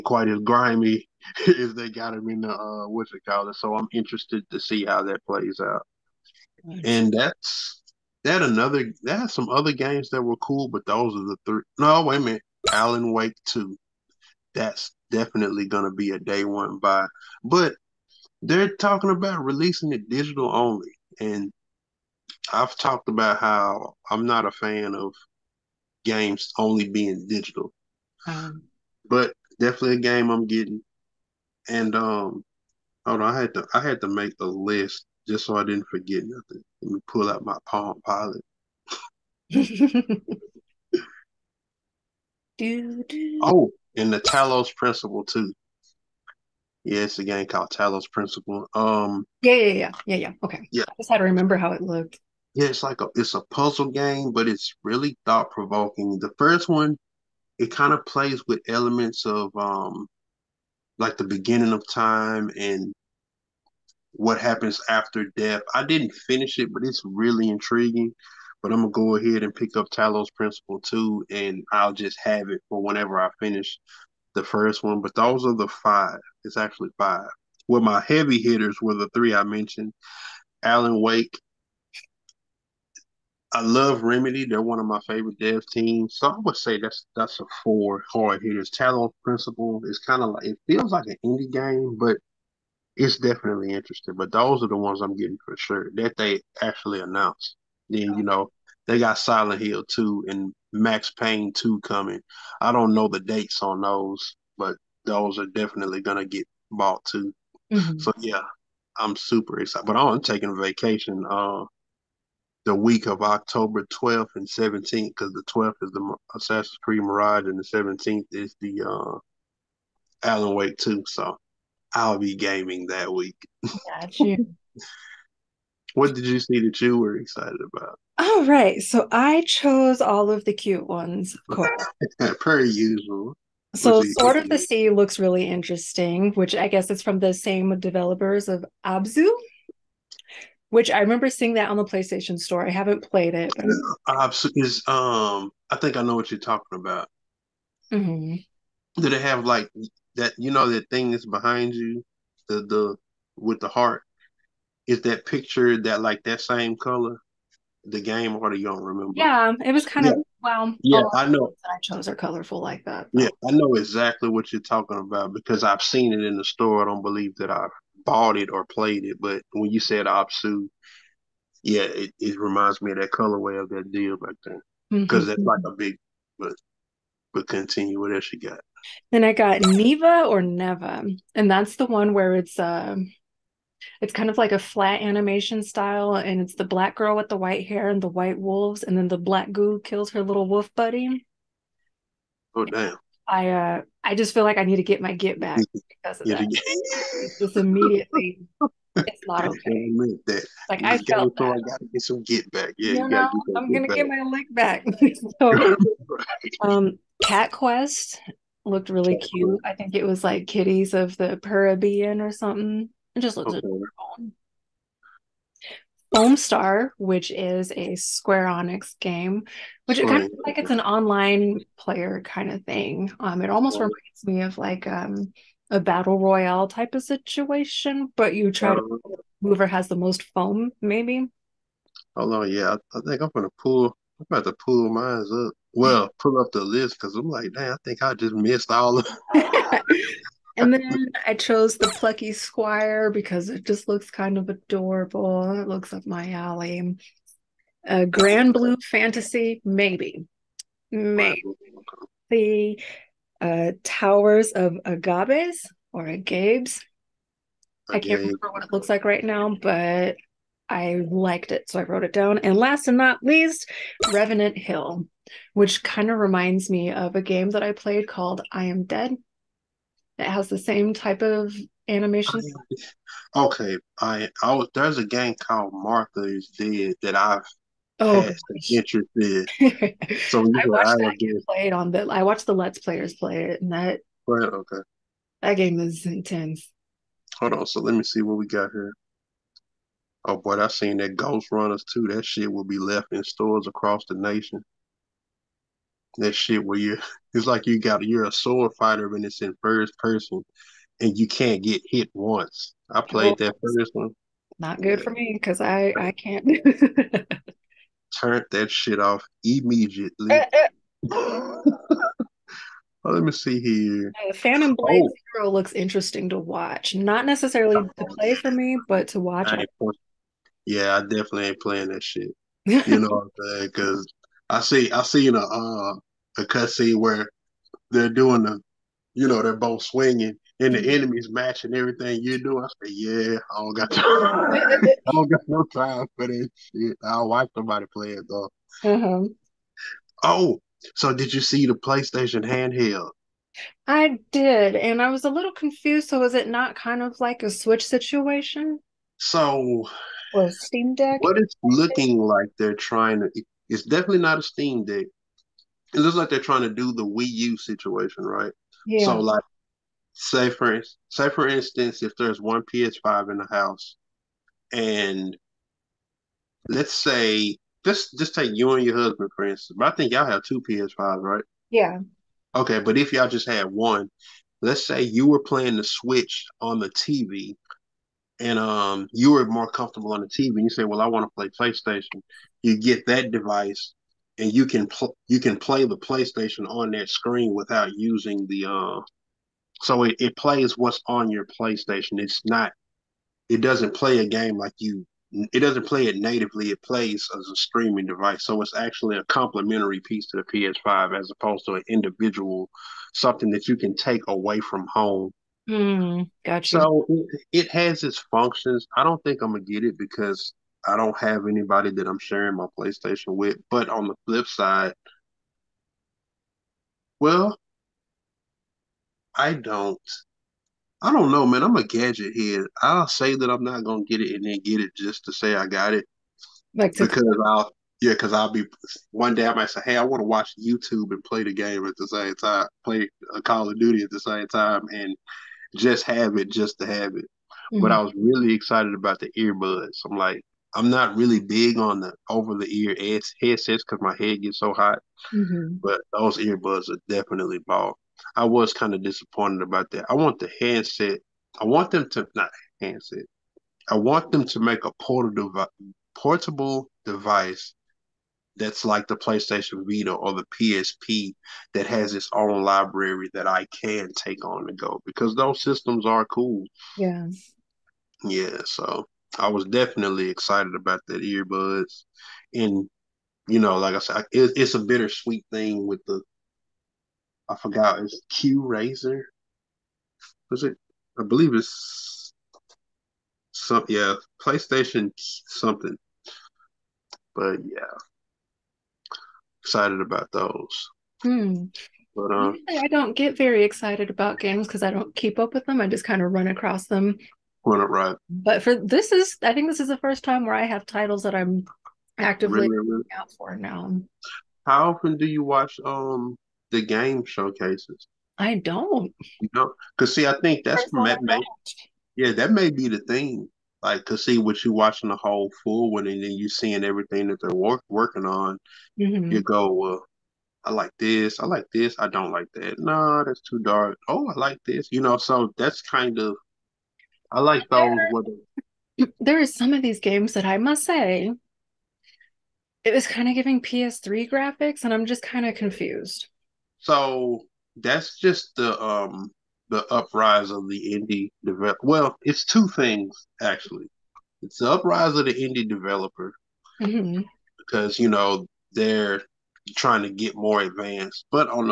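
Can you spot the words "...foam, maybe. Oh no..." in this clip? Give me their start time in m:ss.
3:50.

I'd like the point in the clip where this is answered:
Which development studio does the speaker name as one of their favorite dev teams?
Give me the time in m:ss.
1:24.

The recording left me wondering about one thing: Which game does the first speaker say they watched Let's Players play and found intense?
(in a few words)
Martha's Dead.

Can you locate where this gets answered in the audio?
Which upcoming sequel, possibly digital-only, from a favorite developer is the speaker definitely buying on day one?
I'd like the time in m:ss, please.
0:12.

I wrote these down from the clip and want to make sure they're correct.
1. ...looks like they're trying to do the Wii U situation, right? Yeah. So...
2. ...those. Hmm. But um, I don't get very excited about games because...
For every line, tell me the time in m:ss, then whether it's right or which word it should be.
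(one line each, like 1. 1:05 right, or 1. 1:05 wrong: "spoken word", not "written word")
1. 5:55 right
2. 8:10 right.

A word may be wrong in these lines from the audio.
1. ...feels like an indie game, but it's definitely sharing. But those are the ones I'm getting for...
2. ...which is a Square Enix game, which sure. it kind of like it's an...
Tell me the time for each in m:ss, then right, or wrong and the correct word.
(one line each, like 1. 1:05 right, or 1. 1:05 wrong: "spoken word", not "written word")
1. 1:30 wrong: "interesting", not "sharing"
2. 3:36 right.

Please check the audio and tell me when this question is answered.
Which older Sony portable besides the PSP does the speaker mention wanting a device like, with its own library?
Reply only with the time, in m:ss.
7:39.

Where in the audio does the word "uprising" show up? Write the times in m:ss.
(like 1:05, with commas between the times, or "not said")
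8:59, 9:04.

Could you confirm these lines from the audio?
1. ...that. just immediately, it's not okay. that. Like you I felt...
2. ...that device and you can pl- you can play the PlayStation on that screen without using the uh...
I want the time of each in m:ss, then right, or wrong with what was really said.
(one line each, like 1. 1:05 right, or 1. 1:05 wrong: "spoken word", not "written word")
1. 3:16 right
2. 6:23 right.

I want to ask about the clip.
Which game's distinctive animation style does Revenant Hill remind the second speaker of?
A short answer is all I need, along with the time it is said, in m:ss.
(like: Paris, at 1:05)
I Am Dead, at 4:28.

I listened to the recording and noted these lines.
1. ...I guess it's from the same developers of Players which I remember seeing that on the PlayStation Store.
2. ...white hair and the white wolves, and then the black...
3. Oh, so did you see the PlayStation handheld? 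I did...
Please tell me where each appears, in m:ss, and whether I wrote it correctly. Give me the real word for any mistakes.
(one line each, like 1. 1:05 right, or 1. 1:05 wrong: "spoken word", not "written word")
1. 2:16 wrong: "Abzu", not "Players"
2. 3:07 right
3. 5:40 right.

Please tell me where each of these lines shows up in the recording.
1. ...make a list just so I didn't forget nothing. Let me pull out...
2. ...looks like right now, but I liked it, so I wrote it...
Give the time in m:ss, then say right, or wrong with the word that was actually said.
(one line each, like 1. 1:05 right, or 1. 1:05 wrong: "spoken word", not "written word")
1. 0:34 right
2. 4:18 right.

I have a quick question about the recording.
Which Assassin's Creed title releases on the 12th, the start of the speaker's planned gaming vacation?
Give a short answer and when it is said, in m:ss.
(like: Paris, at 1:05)
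Assassin's Creed Mirage, at 1:56.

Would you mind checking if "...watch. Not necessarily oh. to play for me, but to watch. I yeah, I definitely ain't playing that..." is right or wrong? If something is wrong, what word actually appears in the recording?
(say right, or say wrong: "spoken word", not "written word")
right.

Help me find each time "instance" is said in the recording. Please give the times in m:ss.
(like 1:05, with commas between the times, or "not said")
6:01, 6:09.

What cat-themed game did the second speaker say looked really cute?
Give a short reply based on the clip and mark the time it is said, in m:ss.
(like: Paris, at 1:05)
Cat Quest, at 3:27.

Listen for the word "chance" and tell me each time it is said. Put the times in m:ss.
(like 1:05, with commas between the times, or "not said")
not said.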